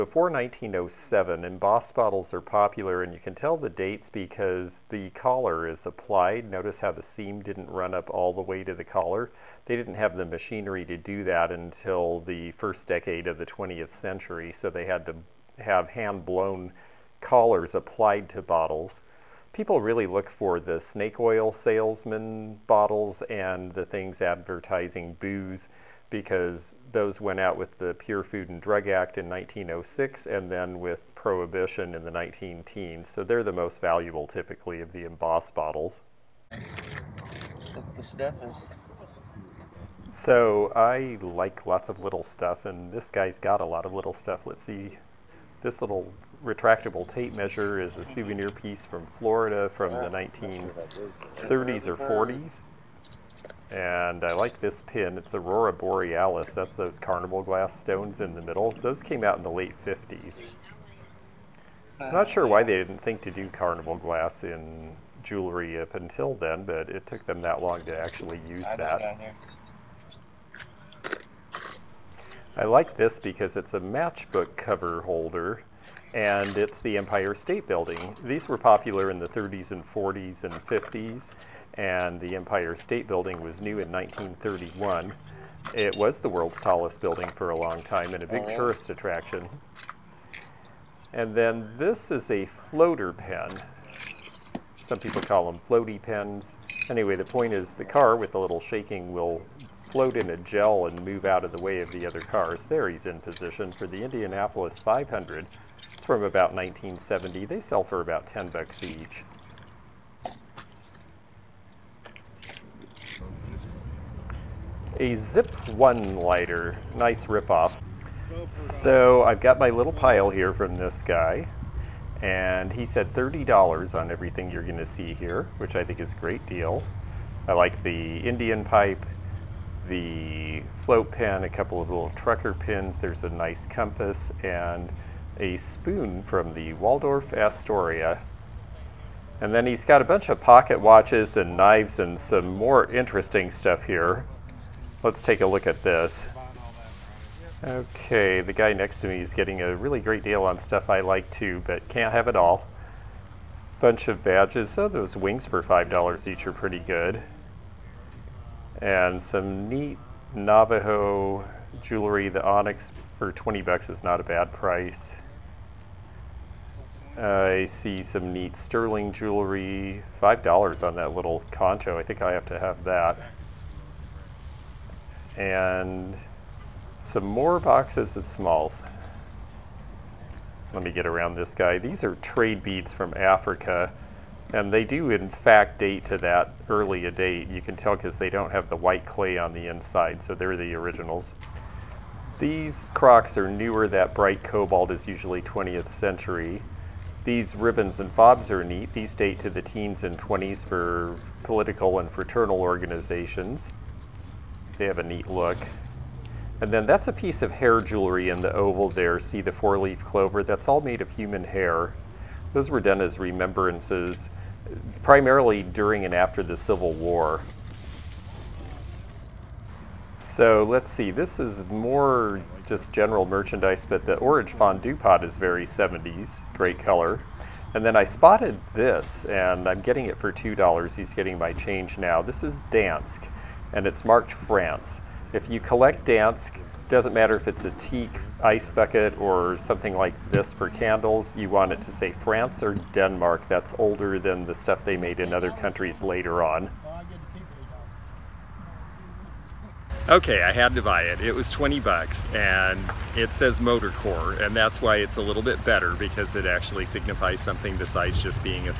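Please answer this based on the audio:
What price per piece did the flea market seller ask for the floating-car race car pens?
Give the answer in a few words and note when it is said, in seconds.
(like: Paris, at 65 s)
$10, at 108 s.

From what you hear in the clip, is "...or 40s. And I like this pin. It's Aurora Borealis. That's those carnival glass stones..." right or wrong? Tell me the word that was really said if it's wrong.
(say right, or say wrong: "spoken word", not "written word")
right.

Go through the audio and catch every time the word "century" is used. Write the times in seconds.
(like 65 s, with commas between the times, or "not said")
13 s, 195 s.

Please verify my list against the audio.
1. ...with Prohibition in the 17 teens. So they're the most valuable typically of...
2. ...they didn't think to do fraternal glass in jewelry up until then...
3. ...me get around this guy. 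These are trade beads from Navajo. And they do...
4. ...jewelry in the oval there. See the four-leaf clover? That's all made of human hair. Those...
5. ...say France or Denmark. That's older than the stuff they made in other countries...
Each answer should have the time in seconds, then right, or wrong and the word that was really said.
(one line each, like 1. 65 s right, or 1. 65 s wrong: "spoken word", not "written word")
1. 30 s wrong: "19", not "17"
2. 62 s wrong: "carnival", not "fraternal"
3. 180 s wrong: "Africa", not "Navajo"
4. 207 s right
5. 241 s right.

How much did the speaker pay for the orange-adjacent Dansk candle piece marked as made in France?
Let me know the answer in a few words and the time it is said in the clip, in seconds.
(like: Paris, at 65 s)
$2, at 230 s.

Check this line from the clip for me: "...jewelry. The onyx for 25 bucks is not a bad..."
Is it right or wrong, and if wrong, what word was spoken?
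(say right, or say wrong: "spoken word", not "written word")
wrong: "20", not "25".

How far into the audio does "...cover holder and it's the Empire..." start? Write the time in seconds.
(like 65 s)
74 s.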